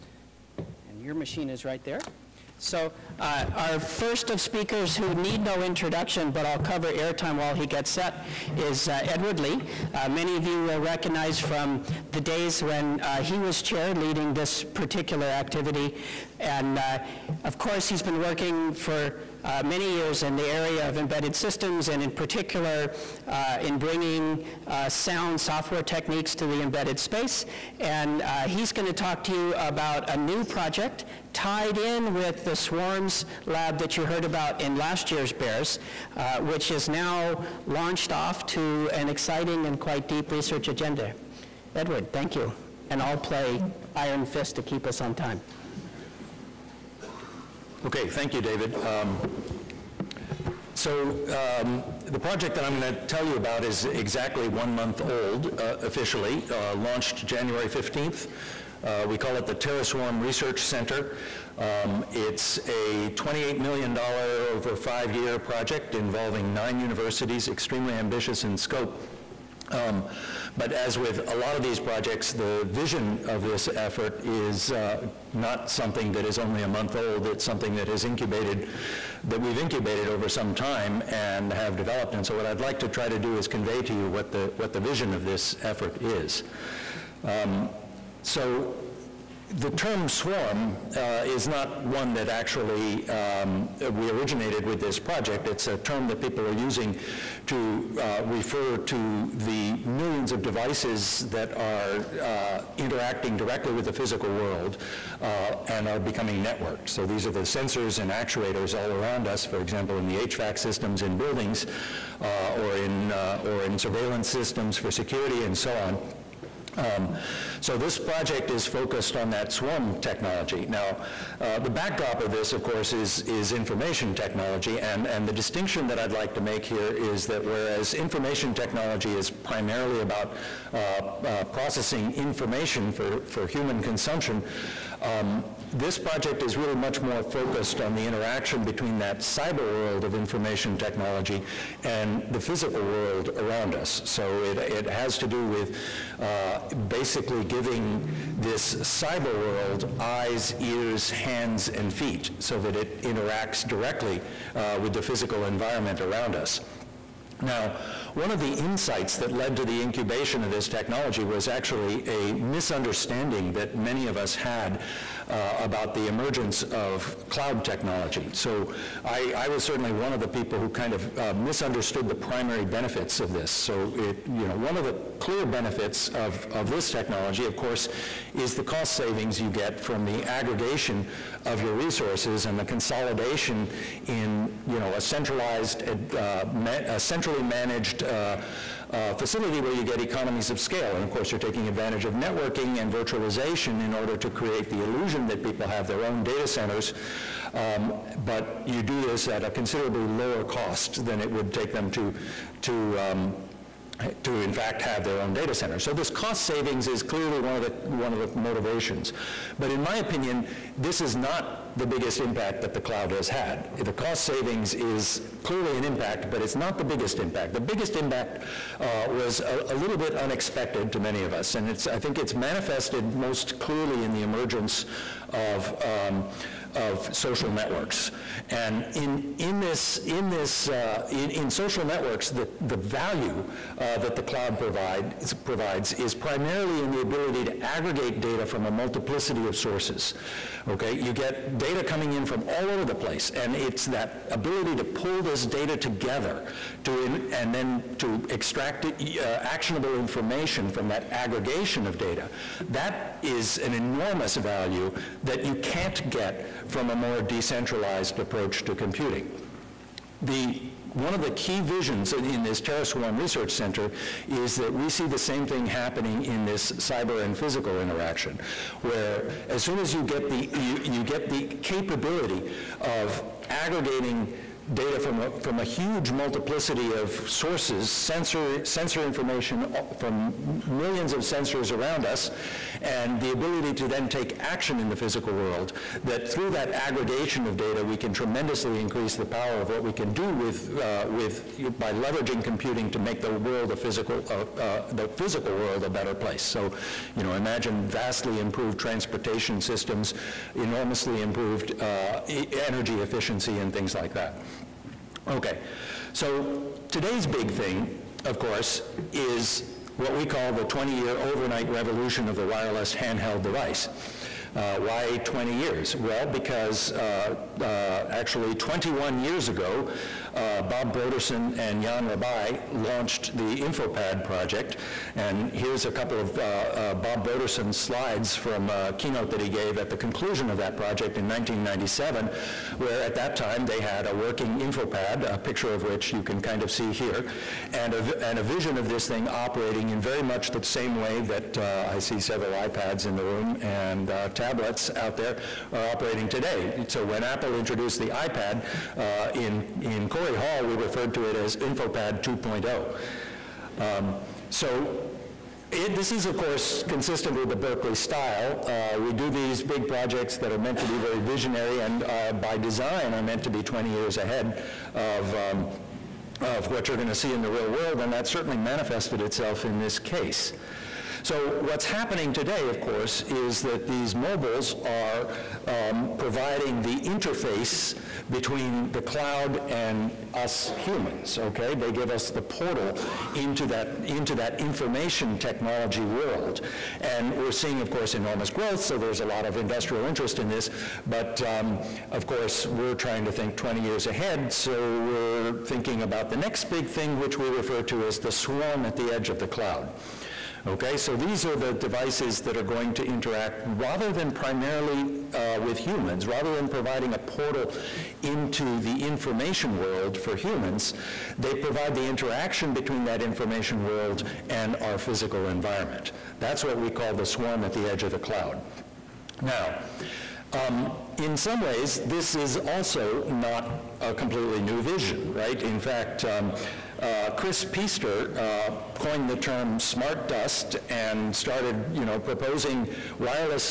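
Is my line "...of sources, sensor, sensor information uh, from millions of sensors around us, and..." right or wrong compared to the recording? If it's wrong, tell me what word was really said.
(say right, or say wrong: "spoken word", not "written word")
right.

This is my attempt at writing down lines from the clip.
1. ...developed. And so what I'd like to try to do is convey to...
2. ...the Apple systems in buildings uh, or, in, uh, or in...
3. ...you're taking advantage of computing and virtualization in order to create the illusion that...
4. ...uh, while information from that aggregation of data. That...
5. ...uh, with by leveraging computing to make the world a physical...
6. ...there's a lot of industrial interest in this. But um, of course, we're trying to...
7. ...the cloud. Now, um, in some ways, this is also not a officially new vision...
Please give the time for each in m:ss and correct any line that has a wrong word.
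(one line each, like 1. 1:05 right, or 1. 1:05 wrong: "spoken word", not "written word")
1. 1:21 right
2. 1:50 wrong: "HVAC", not "Apple"
3. 3:11 wrong: "networking", not "computing"
4. 4:09 wrong: "actionable", not "while"
5. 4:50 right
6. 6:28 right
7. 6:58 wrong: "completely", not "officially".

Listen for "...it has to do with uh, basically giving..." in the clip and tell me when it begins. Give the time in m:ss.
2:24.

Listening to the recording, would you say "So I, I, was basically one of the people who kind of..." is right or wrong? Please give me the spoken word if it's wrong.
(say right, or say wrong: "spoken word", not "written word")
wrong: "certainly", not "basically".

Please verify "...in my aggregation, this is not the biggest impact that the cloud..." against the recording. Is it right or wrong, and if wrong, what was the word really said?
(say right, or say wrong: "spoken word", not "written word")
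wrong: "opinion", not "aggregation".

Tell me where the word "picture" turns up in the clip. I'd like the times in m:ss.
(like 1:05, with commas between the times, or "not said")
5:35.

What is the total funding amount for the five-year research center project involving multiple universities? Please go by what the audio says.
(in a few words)
$28 million.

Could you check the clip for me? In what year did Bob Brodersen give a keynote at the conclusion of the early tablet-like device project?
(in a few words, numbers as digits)
1997.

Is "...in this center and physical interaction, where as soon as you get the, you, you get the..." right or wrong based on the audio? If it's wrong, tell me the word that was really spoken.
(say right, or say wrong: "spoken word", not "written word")
wrong: "cyber", not "center".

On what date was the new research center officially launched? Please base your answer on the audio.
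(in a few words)
January 15th.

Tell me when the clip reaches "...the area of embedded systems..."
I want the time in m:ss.
0:20.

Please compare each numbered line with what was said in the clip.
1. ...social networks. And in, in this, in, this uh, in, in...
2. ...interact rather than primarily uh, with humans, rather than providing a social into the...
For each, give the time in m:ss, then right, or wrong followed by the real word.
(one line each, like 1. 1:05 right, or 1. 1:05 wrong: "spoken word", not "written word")
1. 3:47 right
2. 6:43 wrong: "portal", not "social".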